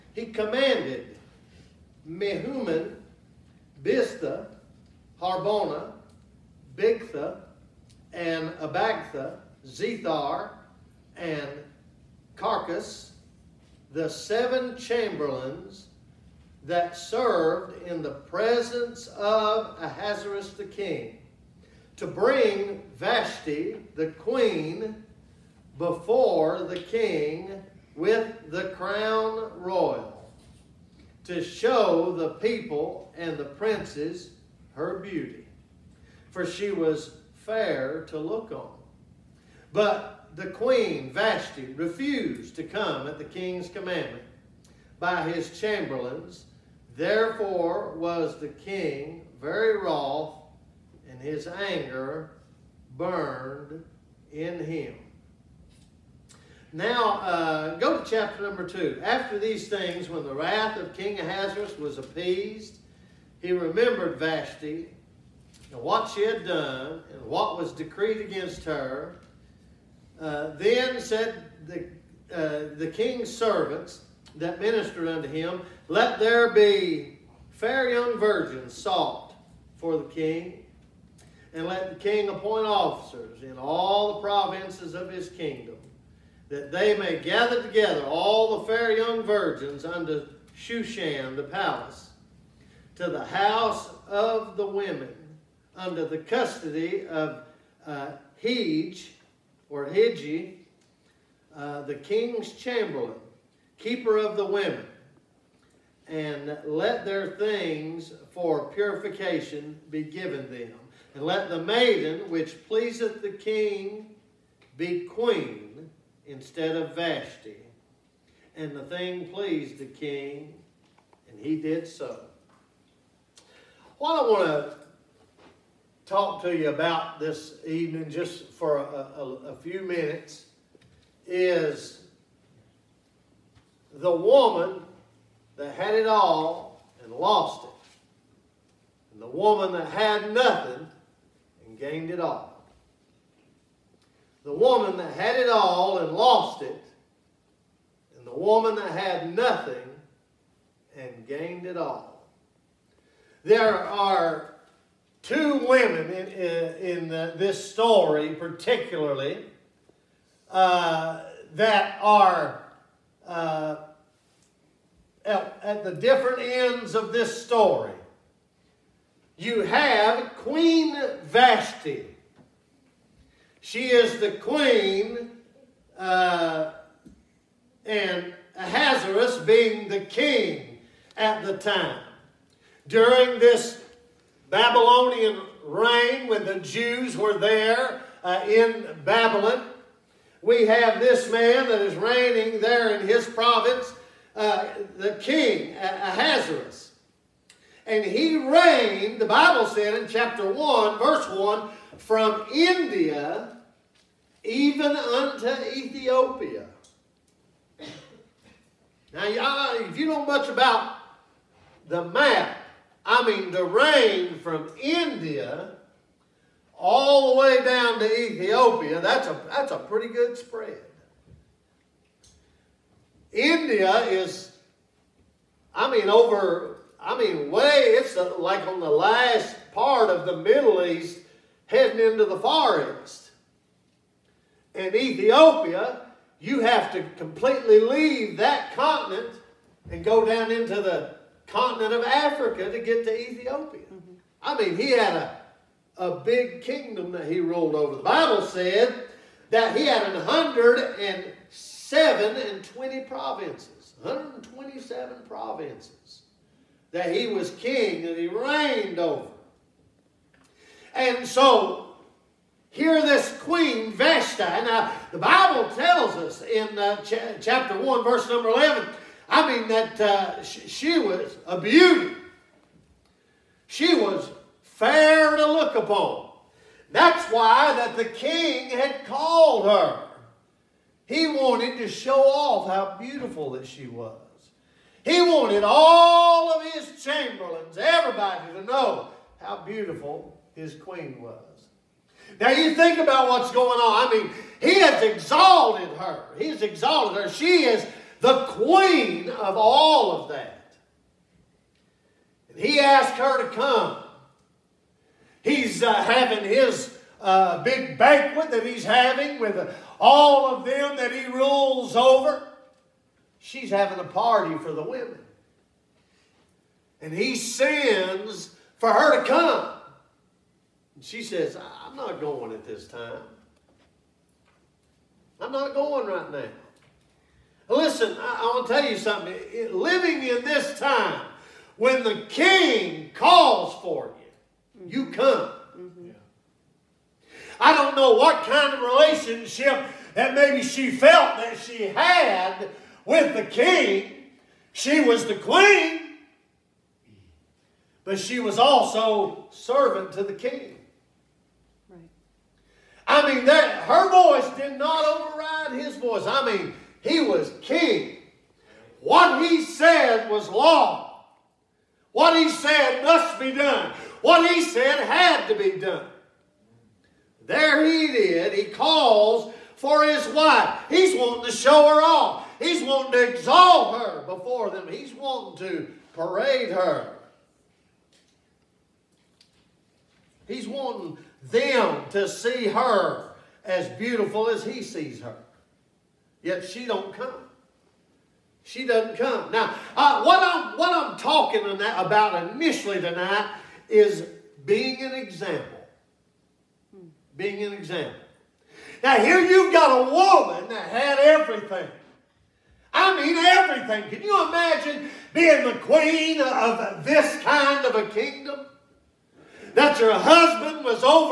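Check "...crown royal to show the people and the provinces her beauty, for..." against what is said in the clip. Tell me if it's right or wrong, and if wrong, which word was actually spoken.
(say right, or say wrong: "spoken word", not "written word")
wrong: "princes", not "provinces".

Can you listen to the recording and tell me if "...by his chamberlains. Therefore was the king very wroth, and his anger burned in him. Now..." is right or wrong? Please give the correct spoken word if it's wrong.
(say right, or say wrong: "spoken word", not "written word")
right.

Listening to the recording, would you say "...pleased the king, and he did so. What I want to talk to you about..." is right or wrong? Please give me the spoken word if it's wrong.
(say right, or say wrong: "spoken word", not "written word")
right.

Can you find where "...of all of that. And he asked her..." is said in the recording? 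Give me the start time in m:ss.
4:59.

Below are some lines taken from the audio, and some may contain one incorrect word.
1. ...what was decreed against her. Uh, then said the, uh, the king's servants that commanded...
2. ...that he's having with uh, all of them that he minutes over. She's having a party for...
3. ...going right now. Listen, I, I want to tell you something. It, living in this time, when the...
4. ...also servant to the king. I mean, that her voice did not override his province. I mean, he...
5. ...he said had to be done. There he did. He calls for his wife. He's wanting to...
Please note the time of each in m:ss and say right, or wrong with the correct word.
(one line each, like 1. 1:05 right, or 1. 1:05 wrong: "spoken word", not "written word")
1. 1:07 wrong: "ministered", not "commanded"
2. 5:08 wrong: "rules", not "minutes"
3. 5:25 right
4. 5:48 wrong: "voice", not "province"
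5. 6:04 right.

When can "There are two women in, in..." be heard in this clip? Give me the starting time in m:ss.
2:33.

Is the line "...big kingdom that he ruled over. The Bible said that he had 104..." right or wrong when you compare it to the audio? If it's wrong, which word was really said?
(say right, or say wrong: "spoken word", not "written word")
wrong: "107", not "104".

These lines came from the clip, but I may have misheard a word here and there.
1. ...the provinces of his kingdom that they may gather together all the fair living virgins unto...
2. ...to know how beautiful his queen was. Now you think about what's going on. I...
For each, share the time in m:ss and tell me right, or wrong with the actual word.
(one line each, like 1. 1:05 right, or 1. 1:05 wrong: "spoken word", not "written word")
1. 1:24 wrong: "young", not "living"
2. 4:48 right.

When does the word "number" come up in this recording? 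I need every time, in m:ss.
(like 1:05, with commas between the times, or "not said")
0:58, 4:28.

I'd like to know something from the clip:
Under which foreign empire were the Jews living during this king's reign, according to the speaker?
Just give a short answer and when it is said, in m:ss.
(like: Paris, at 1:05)
Babylonian, at 3:04.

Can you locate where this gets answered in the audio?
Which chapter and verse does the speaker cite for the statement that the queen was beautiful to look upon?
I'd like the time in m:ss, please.
4:27.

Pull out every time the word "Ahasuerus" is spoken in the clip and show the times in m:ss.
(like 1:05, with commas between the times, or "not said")
0:19, 1:01, 2:58, 3:15.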